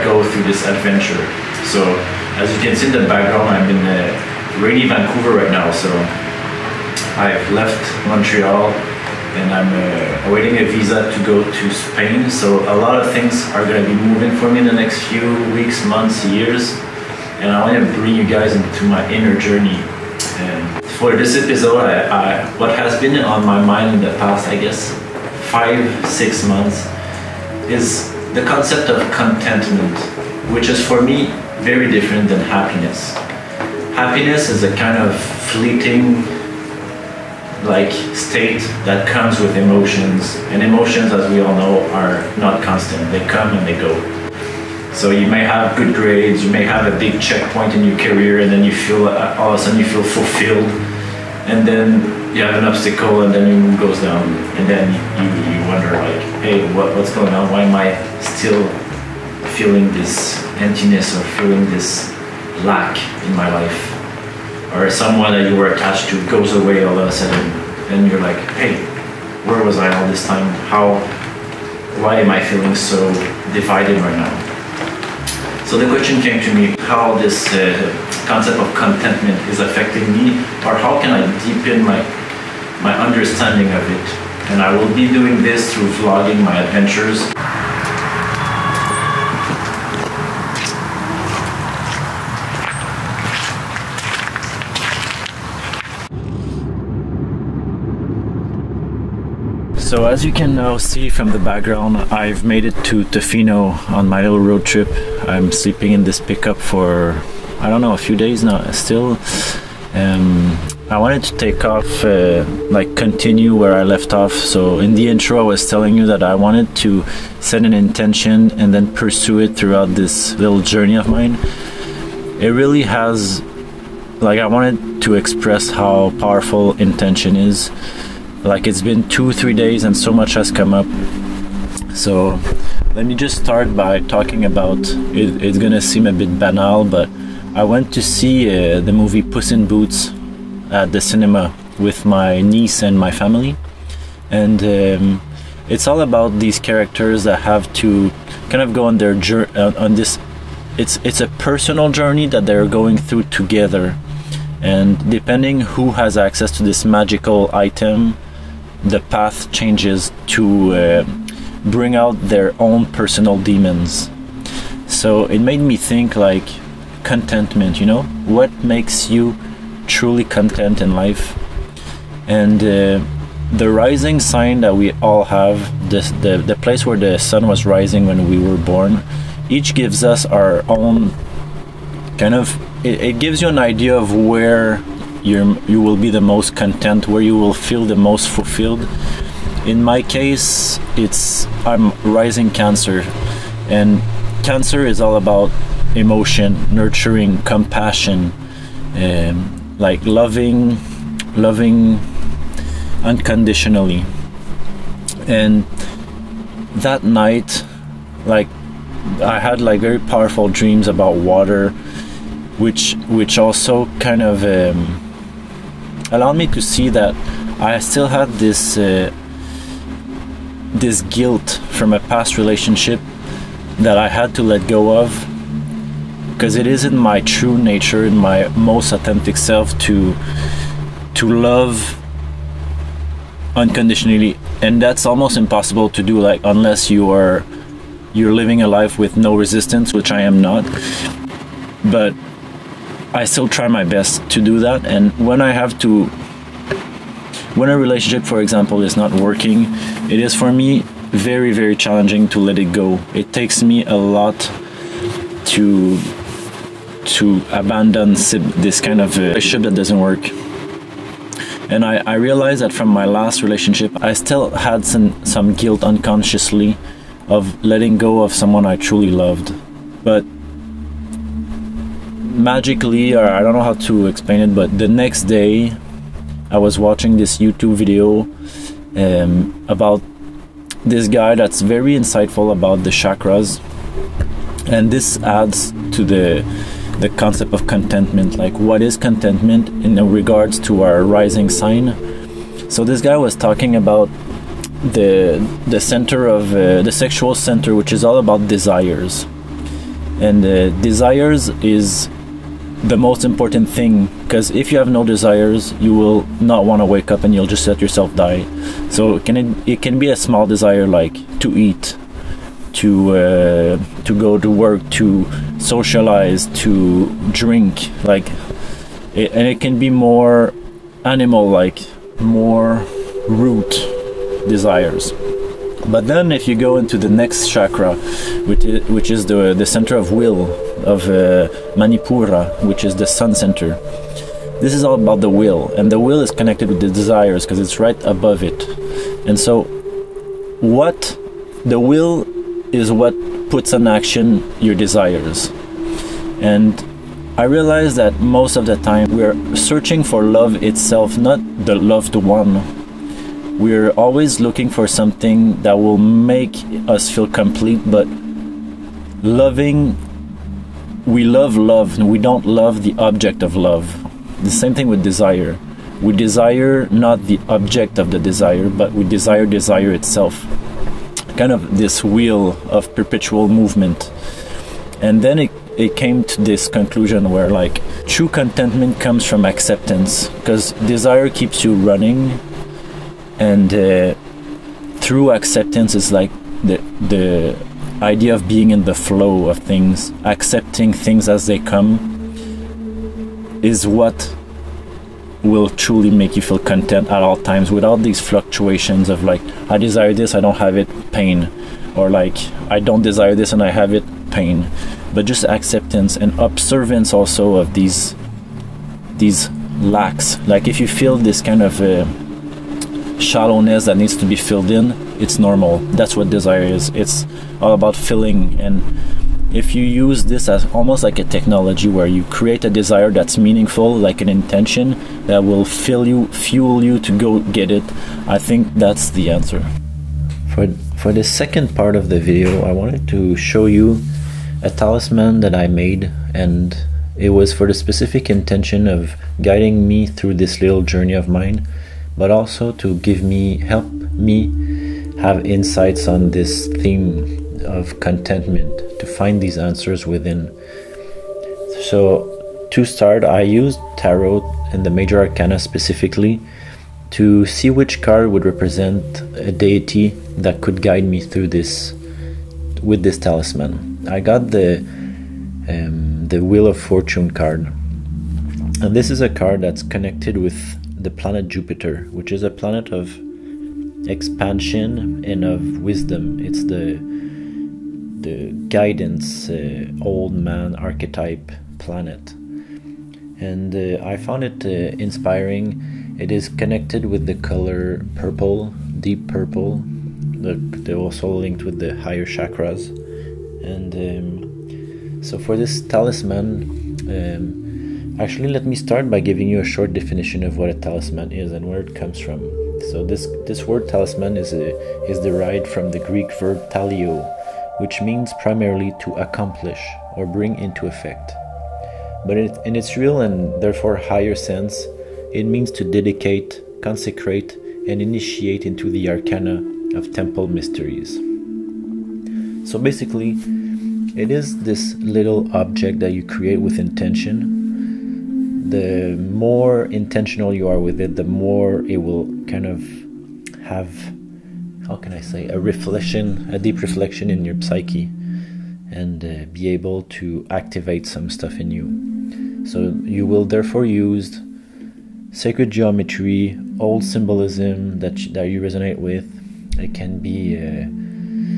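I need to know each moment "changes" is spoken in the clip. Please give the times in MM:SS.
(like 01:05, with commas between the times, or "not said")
02:39.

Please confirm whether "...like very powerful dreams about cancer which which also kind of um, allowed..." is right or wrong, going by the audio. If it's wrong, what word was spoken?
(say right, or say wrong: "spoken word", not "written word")
wrong: "water", not "cancer".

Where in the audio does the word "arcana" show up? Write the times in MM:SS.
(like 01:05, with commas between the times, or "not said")
07:35, 08:39.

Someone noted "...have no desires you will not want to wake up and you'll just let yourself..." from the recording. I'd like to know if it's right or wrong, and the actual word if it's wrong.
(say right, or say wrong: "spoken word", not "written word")
right.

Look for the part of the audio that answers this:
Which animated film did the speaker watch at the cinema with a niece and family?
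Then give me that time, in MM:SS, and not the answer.
02:19.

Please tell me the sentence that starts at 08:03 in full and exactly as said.
And uh, I found it uh, inspiring.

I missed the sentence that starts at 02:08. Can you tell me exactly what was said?
Like, it's been two, three days, and so much has come up.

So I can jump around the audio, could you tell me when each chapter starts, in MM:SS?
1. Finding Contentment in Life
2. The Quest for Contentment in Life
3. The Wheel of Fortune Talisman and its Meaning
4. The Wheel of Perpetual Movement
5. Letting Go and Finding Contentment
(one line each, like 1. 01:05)
1. 02:32
2. 00:56
3. 07:20
4. 05:50
5. 04:09.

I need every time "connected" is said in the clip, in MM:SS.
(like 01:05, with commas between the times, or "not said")
05:36, 07:49, 08:06.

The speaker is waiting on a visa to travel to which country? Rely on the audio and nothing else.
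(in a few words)
Spain.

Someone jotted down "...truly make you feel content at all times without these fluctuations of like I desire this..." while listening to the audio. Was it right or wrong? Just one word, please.
right.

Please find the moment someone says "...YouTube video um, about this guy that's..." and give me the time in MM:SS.
04:37.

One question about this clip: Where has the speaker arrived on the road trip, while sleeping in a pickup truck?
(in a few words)
Tofino.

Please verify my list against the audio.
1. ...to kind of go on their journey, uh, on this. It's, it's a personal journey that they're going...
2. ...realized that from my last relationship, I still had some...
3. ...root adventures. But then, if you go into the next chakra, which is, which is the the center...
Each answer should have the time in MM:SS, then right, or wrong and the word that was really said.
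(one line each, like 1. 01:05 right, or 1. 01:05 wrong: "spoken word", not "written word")
1. 02:27 right
2. 04:22 right
3. 05:23 wrong: "desires", not "adventures".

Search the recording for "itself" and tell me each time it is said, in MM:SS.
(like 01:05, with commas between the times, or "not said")
05:50, 06:09.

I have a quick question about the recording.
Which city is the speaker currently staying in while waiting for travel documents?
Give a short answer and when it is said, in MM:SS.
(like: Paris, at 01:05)
Vancouver, at 00:04.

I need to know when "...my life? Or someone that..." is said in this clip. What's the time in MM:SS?
01:03.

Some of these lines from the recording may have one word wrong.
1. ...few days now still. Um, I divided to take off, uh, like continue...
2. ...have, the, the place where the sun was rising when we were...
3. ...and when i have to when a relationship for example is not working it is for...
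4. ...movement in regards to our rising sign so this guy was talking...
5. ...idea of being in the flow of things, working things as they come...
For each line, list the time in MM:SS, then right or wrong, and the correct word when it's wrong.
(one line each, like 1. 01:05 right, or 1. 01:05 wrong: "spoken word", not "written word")
1. 01:47 wrong: "wanted", not "divided"
2. 02:55 right
3. 04:04 right
4. 04:48 wrong: "contentment", not "movement"
5. 06:28 wrong: "accepting", not "working".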